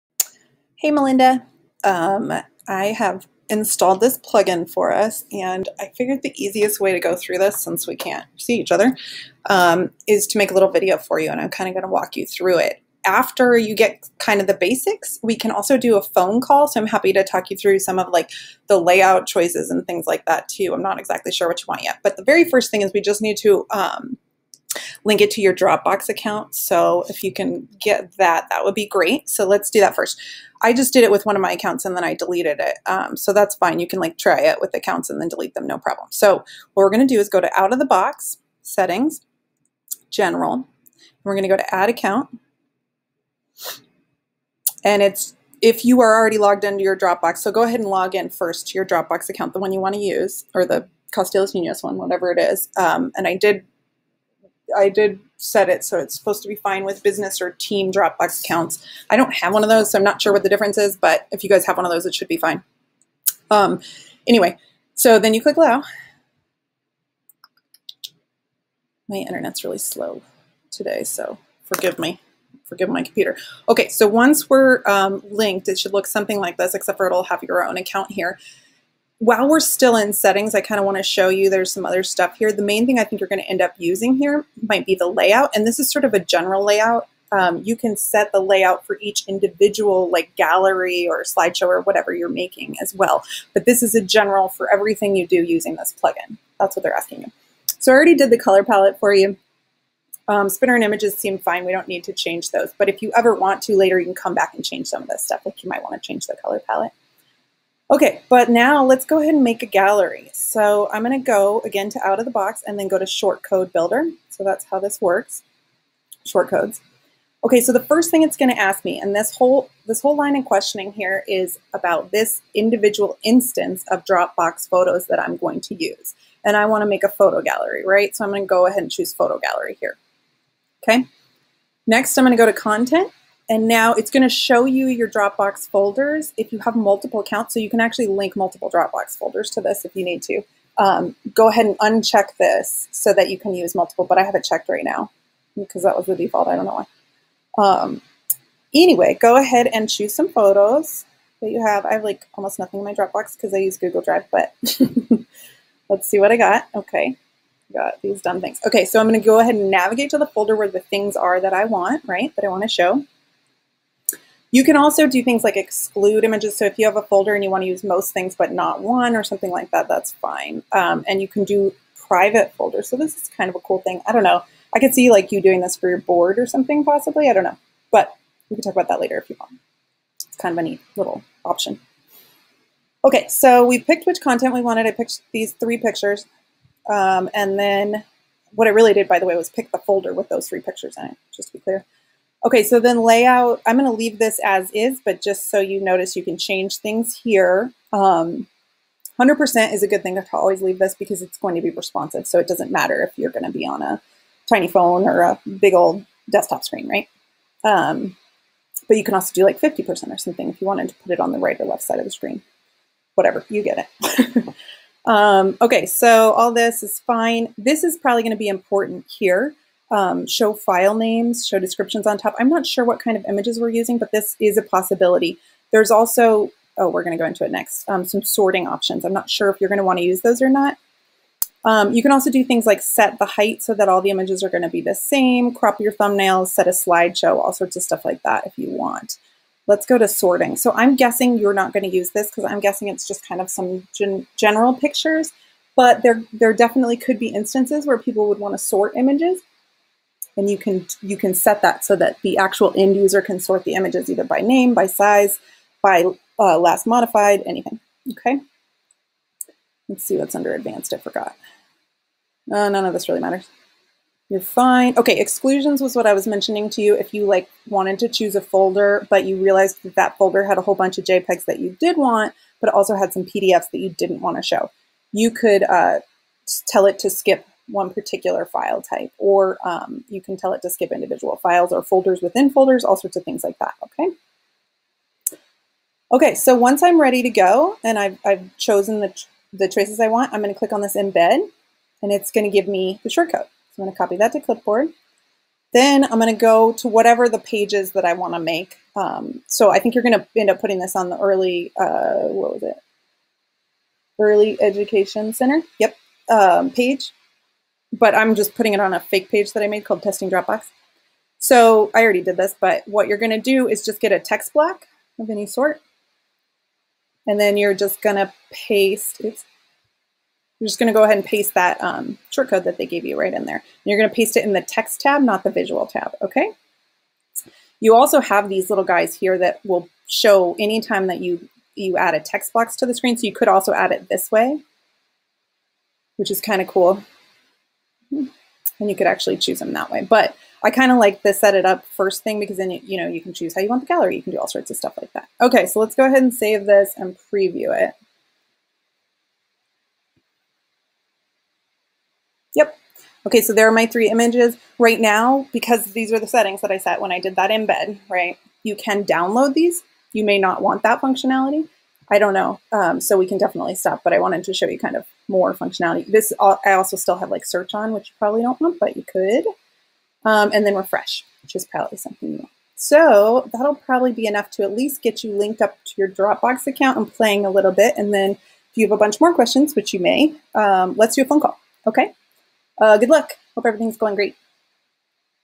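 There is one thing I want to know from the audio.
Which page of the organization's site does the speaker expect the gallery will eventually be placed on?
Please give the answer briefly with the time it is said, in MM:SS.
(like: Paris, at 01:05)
Early Education Center, at 05:04.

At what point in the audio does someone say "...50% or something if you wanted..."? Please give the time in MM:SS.
03:29.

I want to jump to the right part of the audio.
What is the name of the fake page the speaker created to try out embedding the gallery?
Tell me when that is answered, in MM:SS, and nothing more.
05:10.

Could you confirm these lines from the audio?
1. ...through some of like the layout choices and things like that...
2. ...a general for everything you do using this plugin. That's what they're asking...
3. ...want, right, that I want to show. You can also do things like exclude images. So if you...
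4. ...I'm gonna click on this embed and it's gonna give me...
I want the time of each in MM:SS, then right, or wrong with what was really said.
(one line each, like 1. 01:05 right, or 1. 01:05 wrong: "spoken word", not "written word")
1. 00:17 right
2. 01:33 right
3. 02:41 right
4. 04:50 right.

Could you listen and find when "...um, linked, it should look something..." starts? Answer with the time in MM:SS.
01:14.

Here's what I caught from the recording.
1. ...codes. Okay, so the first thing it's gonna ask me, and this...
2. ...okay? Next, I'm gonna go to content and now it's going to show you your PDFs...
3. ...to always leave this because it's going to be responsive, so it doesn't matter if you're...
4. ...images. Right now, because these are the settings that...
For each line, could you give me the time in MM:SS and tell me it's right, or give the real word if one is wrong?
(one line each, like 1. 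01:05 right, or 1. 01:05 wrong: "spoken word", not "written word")
1. 01:56 right
2. 02:10 wrong: "Dropbox", not "PDFs"
3. 03:20 right
4. 05:54 right.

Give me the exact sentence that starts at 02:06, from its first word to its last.
And I wanna make a photo gallery, right?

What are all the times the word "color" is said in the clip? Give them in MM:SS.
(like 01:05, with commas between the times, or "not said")
01:38, 01:46.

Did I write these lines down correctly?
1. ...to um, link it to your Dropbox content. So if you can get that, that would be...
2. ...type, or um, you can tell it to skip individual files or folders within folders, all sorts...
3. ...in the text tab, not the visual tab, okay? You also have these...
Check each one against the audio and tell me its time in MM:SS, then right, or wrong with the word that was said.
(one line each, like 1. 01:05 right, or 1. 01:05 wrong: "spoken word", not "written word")
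1. 00:23 wrong: "account", not "content"
2. 04:38 right
3. 05:24 right.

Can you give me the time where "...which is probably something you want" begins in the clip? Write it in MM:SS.
06:11.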